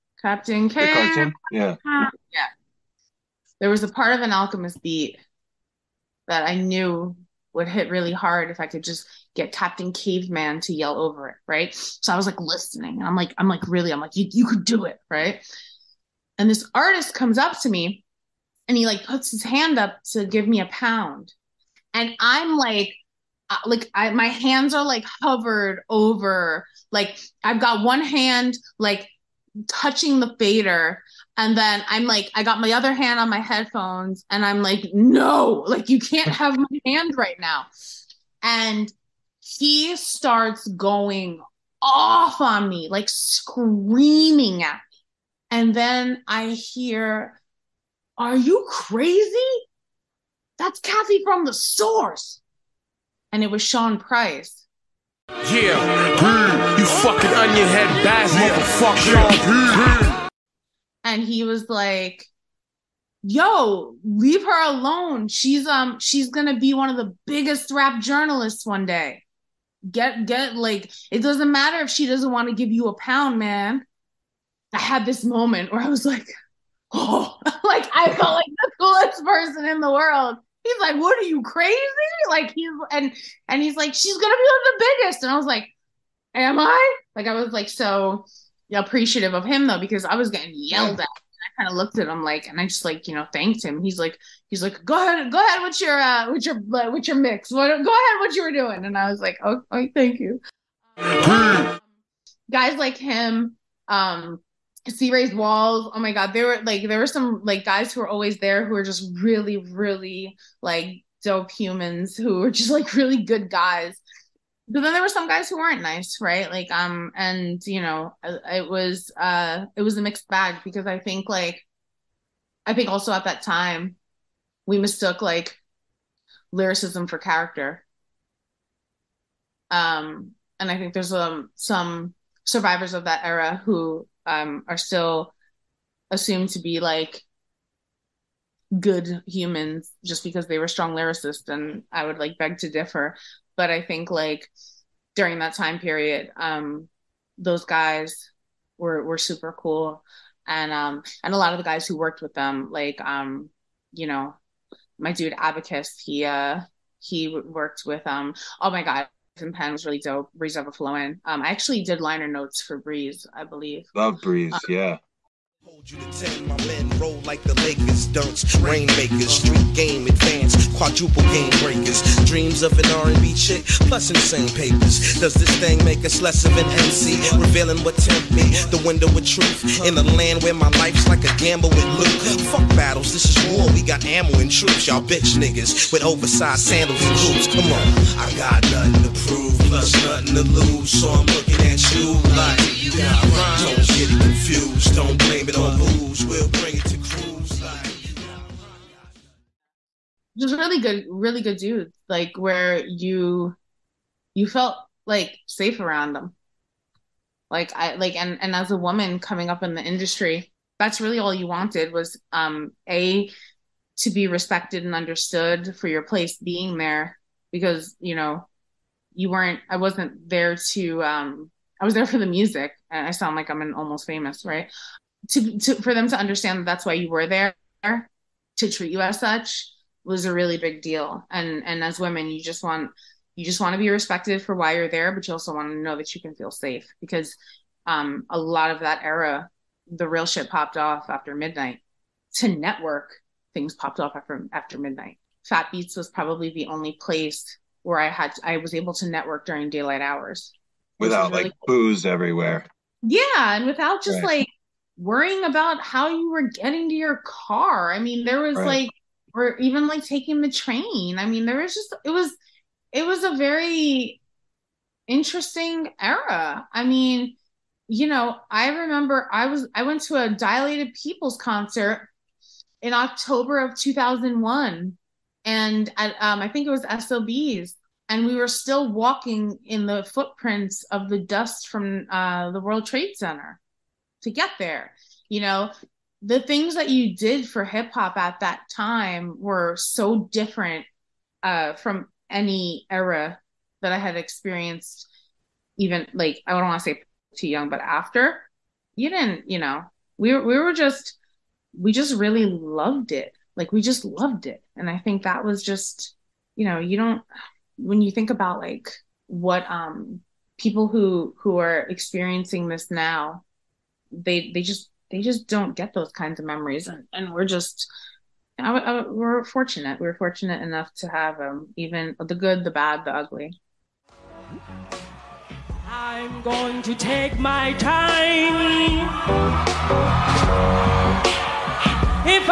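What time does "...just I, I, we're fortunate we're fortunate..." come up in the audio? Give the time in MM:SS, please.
05:17.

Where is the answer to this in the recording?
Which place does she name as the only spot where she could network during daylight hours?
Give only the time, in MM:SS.
04:05.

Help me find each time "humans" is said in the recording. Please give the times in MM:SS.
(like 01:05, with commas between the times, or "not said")
01:51, 02:19.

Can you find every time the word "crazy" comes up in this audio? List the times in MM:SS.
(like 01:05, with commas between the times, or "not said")
00:48, 01:21.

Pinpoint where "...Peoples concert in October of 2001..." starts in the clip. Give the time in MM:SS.
04:31.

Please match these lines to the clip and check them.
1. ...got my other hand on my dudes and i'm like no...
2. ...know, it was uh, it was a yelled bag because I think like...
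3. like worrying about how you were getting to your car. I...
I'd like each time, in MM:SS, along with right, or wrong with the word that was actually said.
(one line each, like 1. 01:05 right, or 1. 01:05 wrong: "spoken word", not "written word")
1. 00:32 wrong: "headphones", not "dudes"
2. 01:57 wrong: "mixed", not "yelled"
3. 04:14 right.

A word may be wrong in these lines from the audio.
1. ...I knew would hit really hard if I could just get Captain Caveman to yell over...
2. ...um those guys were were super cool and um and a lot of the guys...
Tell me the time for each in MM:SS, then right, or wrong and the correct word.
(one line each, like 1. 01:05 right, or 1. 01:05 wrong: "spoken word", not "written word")
1. 00:06 right
2. 02:26 right.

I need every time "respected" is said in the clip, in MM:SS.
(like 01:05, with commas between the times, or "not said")
03:34, 03:53.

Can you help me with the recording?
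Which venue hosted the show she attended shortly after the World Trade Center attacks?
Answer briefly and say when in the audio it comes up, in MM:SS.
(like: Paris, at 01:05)
SOBs, at 04:36.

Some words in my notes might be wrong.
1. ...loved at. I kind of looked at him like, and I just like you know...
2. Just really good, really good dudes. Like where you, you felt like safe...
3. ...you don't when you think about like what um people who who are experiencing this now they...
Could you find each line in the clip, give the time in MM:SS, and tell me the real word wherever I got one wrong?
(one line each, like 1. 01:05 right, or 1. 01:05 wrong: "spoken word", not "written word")
1. 01:30 wrong: "yelled", not "loved"
2. 03:20 right
3. 05:06 right.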